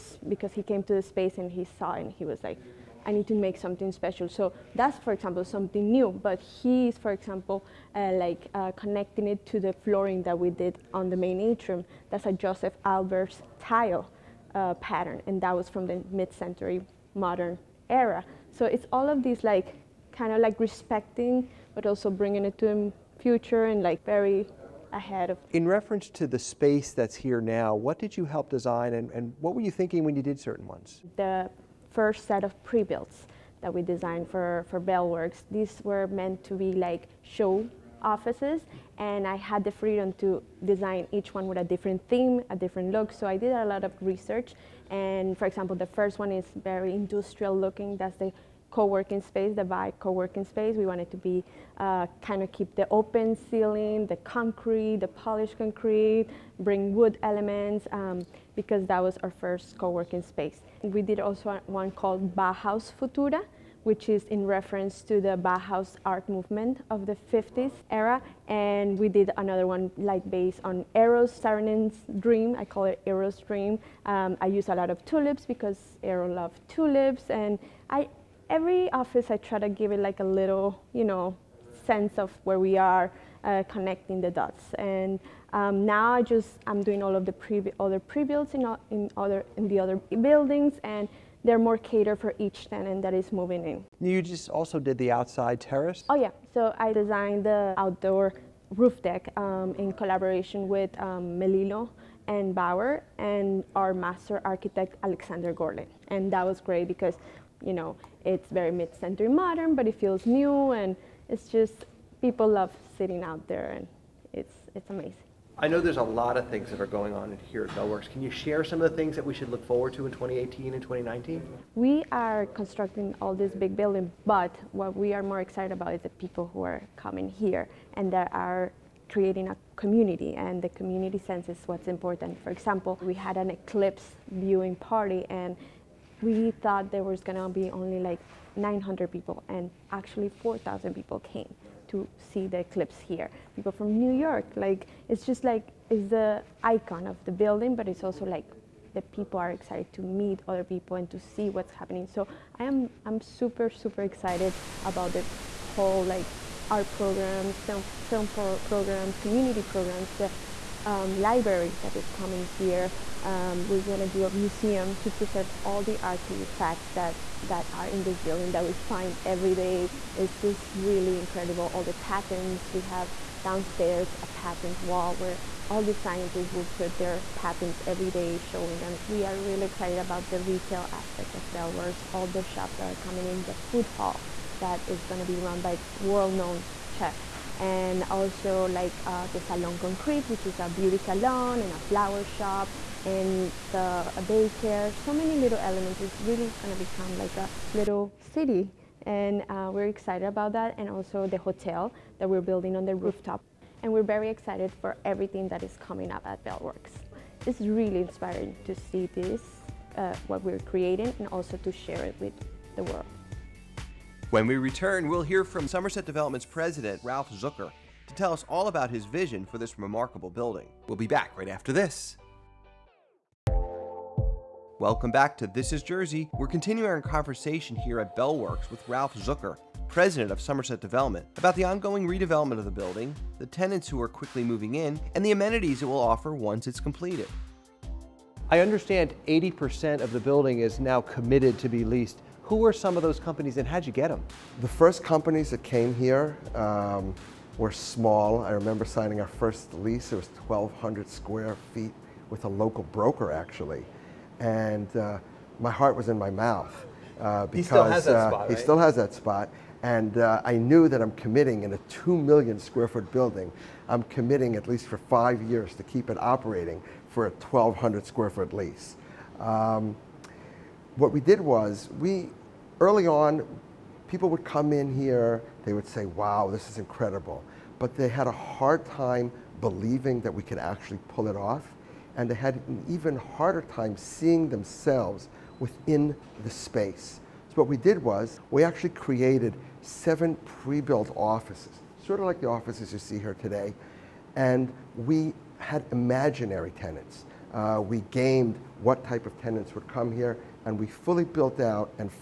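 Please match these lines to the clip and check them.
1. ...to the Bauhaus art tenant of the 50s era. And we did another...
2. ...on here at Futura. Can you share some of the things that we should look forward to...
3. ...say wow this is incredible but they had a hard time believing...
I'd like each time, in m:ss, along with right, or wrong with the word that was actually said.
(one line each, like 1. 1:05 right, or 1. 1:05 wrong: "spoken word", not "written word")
1. 1:05 wrong: "movement", not "tenant"
2. 1:57 wrong: "Bellworks", not "Futura"
3. 4:35 right.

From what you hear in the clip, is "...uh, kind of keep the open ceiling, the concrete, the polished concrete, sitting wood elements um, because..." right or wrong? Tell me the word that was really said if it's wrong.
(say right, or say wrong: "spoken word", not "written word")
wrong: "bring", not "sitting".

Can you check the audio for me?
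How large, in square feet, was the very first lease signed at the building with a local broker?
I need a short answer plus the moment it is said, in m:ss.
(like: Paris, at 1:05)
1,200 square feet, at 4:10.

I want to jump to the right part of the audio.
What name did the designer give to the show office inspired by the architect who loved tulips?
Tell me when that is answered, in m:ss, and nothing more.
1:13.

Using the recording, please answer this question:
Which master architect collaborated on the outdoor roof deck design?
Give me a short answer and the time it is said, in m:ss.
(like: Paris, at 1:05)
Alexander Gorlin, at 1:45.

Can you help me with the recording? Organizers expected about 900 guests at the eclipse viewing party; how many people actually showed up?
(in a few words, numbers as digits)
4,000.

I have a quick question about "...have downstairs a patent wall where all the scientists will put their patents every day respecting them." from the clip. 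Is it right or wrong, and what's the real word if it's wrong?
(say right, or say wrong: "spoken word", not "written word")
wrong: "showing", not "respecting".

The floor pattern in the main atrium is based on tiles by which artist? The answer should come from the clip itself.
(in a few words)
Josef Albers.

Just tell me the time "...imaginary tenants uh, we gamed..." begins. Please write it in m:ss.
4:55.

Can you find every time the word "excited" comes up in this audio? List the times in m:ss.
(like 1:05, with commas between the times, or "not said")
2:05, 2:29, 2:34, 2:59, 3:19, 3:24.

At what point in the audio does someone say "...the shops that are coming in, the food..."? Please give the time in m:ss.
3:02.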